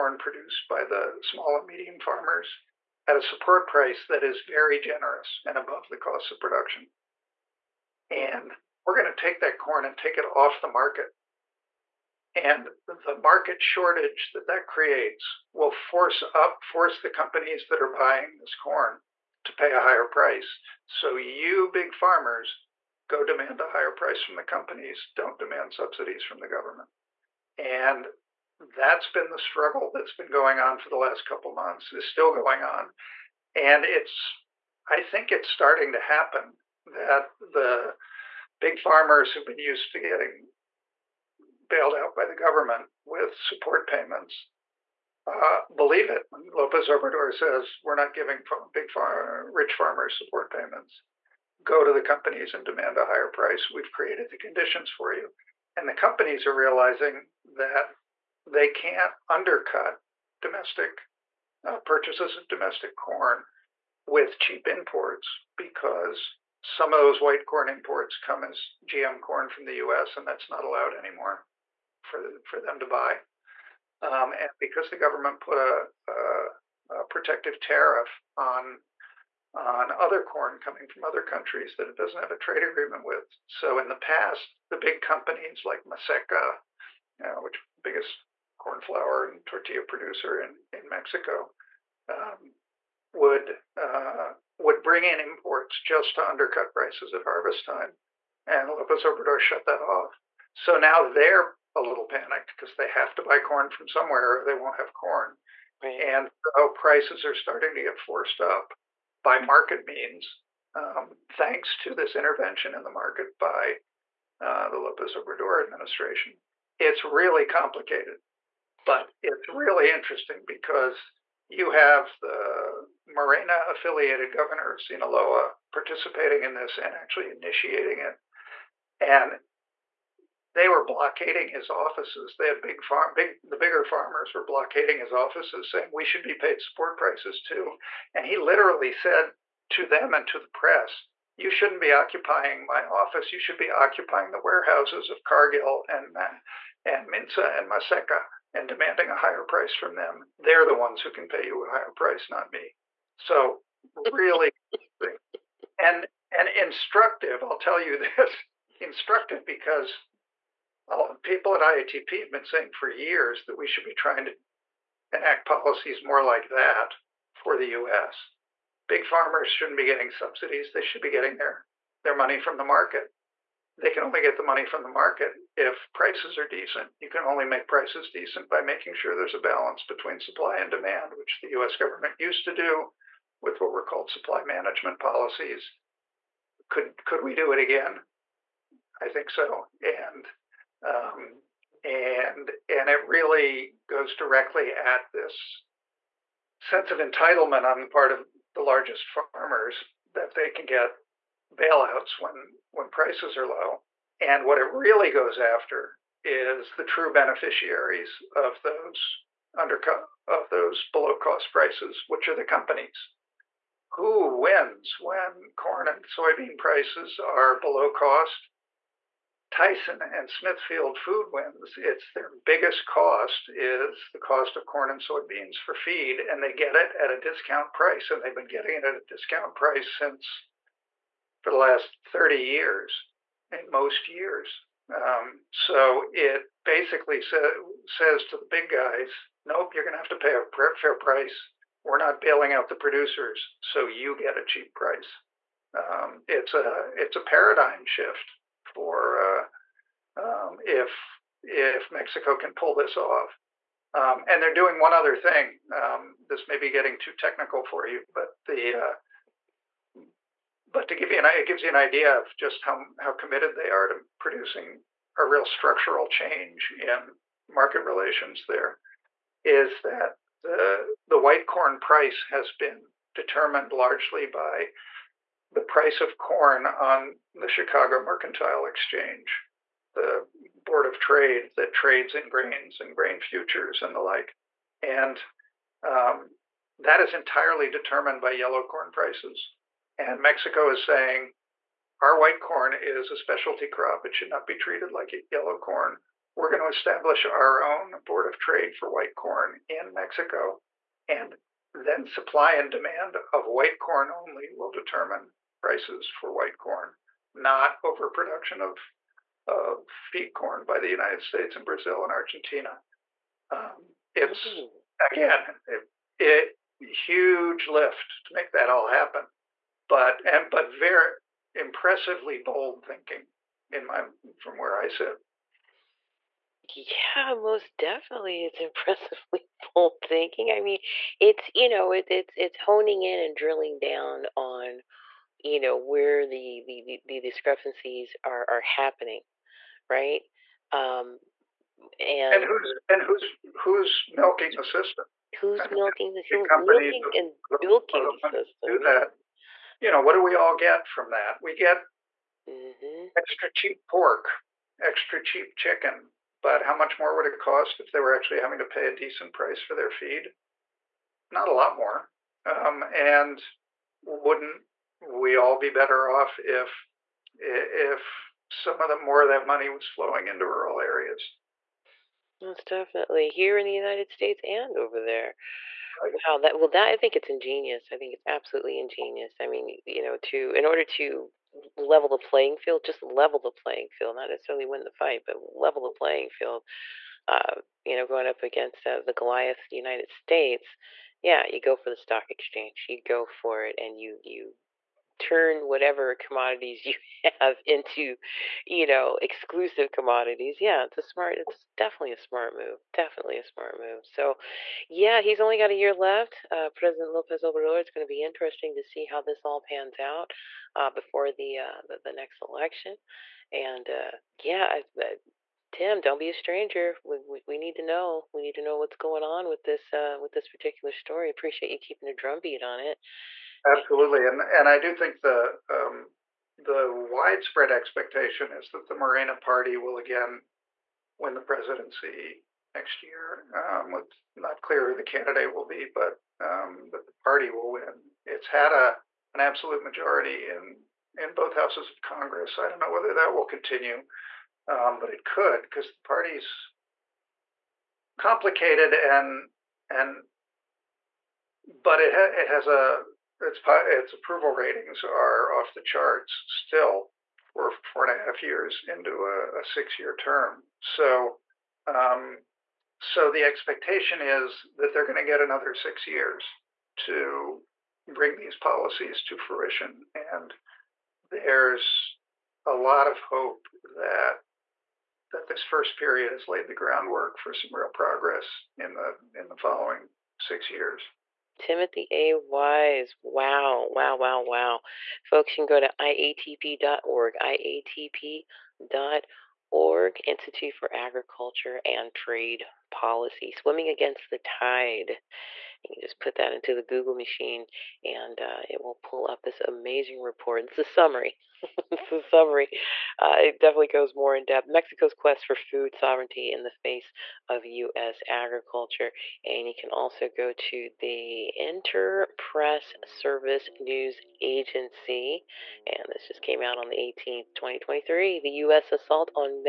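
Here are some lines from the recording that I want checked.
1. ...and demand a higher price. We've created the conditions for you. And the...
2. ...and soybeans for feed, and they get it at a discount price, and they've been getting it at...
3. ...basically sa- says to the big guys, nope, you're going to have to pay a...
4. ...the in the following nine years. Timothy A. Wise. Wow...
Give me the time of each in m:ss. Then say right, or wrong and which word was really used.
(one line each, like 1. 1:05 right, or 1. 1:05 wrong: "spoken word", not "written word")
1. 0:52 right
2. 3:44 right
3. 3:56 right
4. 7:58 wrong: "six", not "nine".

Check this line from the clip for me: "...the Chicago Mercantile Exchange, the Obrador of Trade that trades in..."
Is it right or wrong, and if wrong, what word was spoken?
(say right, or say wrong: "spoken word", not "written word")
wrong: "Board", not "Obrador".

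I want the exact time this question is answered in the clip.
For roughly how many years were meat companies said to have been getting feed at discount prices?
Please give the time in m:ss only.
3:52.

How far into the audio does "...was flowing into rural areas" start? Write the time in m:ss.
6:09.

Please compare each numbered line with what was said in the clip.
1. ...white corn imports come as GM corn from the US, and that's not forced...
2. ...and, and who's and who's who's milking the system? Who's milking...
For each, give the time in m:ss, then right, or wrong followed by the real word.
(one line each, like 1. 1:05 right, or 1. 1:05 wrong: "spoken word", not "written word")
1. 1:07 wrong: "allowed", not "forced"
2. 5:41 right.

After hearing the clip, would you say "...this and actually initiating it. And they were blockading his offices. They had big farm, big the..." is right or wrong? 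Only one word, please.
right.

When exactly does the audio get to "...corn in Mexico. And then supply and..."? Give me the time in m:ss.
4:59.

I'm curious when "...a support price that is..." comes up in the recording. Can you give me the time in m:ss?
0:03.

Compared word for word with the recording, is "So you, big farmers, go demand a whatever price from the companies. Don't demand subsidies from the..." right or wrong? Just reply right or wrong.
wrong.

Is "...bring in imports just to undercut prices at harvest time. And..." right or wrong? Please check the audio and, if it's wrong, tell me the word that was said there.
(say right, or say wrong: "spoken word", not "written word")
right.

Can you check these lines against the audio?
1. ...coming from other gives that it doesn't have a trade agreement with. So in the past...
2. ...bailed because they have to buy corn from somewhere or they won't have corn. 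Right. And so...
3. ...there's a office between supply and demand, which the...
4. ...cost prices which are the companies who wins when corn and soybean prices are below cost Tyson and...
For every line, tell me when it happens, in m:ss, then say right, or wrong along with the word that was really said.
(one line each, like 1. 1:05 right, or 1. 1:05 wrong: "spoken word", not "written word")
1. 1:20 wrong: "countries", not "gives"
2. 1:42 wrong: "panicked", not "bailed"
3. 2:59 wrong: "balance", not "office"
4. 3:31 right.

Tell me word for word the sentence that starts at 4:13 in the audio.
Um, and they're doing one other thing.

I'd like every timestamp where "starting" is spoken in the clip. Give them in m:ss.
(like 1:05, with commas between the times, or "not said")
0:35, 1:47.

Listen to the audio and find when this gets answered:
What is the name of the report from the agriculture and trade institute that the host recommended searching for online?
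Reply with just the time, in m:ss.
8:13.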